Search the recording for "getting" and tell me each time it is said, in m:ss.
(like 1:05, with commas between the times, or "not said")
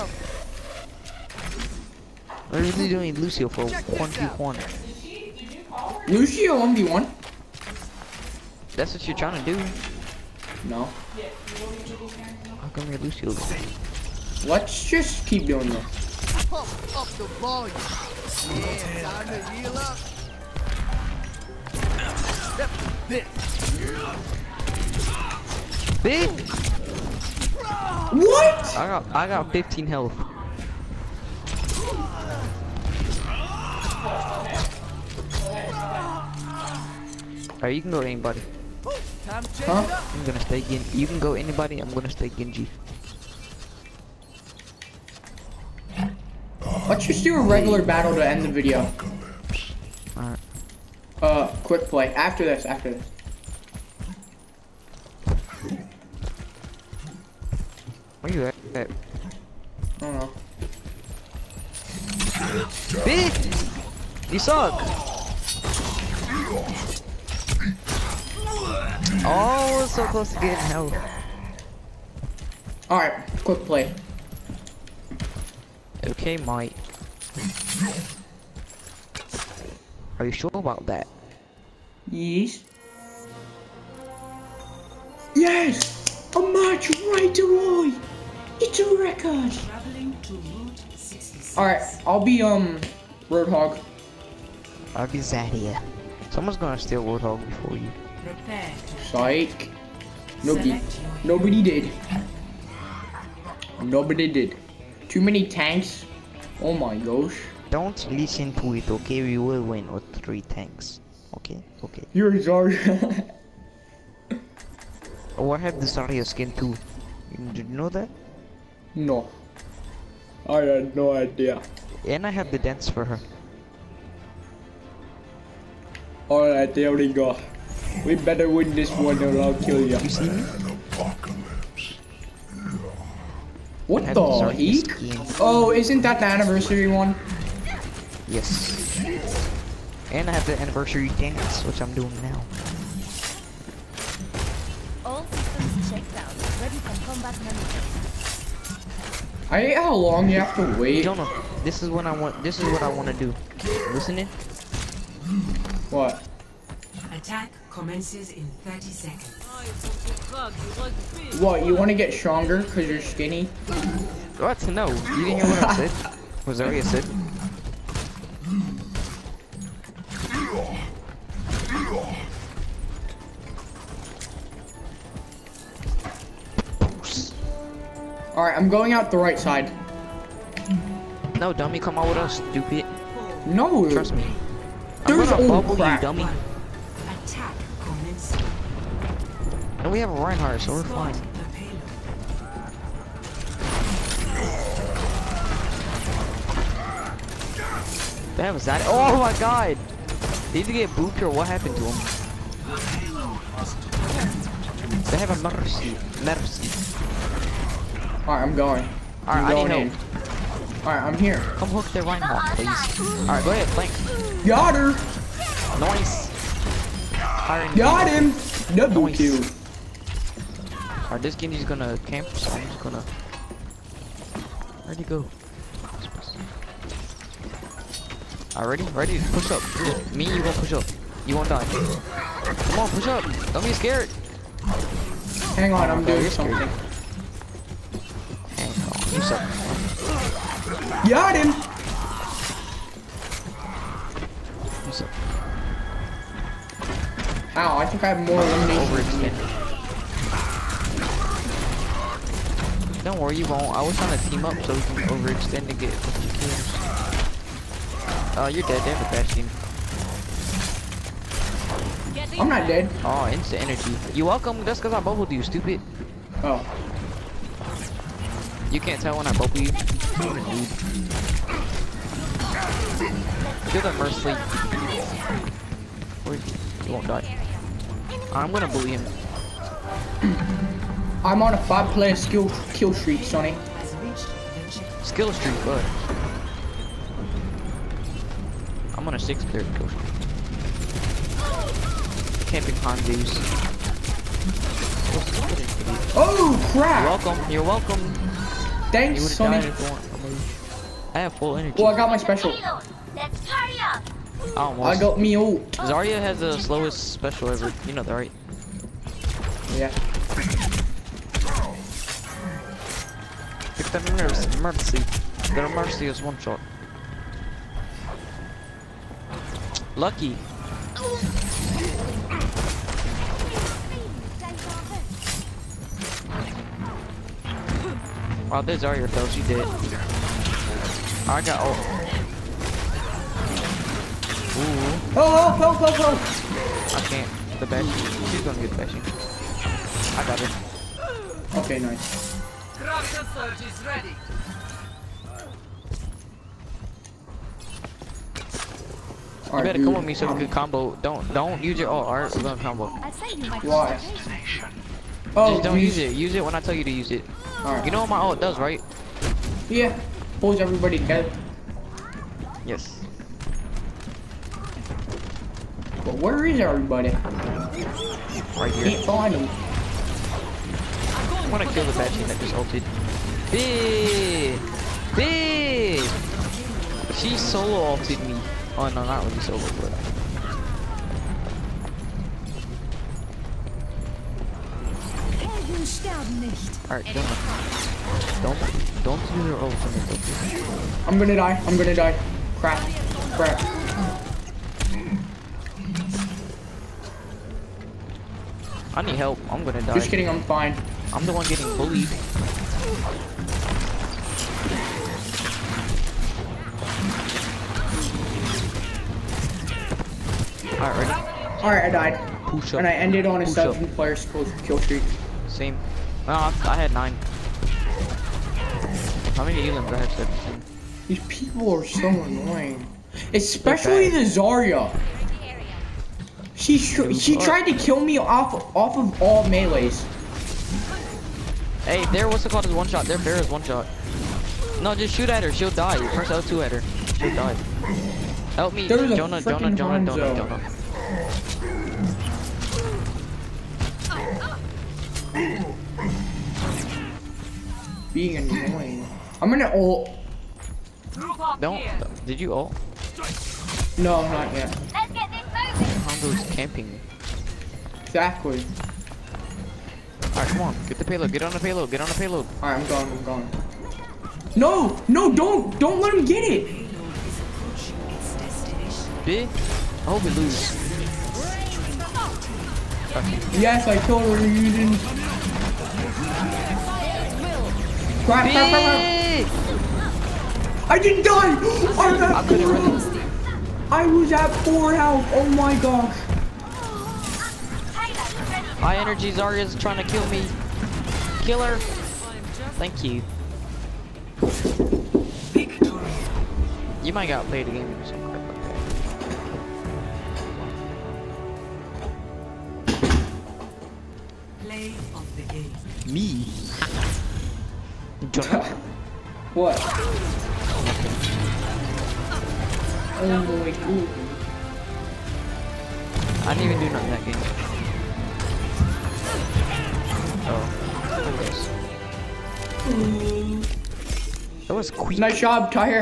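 1:10, 6:41.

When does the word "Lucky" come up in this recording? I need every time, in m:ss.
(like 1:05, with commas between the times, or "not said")
5:19.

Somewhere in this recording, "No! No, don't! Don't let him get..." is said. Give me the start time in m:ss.
7:44.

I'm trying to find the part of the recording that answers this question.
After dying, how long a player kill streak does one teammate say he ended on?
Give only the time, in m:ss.
6:53.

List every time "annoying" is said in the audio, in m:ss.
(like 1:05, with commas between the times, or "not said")
7:02, 7:28.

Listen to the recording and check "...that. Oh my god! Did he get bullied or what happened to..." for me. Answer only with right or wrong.
wrong.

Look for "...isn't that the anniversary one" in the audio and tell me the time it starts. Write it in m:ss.
2:15.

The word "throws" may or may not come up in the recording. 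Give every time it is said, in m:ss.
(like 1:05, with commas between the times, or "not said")
5:29.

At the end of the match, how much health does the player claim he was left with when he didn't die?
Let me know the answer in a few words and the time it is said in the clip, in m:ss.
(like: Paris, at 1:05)
4, at 8:04.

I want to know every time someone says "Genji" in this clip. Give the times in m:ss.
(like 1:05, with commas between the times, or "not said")
0:42, 3:41.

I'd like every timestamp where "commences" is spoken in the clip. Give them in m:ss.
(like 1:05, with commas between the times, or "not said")
2:37.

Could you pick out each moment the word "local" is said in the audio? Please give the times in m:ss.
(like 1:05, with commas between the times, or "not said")
not said.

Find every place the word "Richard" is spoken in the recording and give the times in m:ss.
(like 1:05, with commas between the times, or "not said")
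not said.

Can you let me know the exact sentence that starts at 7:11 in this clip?
Hey, there, what's the called is one shot.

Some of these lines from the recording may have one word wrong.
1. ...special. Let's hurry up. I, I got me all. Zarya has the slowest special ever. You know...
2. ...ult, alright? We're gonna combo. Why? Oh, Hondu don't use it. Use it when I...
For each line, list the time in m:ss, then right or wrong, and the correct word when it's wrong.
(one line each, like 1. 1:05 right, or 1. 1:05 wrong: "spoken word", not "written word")
1. 5:02 right
2. 5:51 wrong: "Just", not "Hondu".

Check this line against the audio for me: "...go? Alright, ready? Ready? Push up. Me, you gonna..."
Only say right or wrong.
right.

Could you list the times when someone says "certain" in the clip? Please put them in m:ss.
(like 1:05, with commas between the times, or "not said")
not said.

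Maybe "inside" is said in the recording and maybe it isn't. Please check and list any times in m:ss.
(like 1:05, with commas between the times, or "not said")
not said.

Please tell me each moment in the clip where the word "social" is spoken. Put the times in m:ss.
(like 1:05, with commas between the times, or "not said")
not said.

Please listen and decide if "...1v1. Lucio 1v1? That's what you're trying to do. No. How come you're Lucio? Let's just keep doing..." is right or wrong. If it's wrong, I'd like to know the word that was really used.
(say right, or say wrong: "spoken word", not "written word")
right.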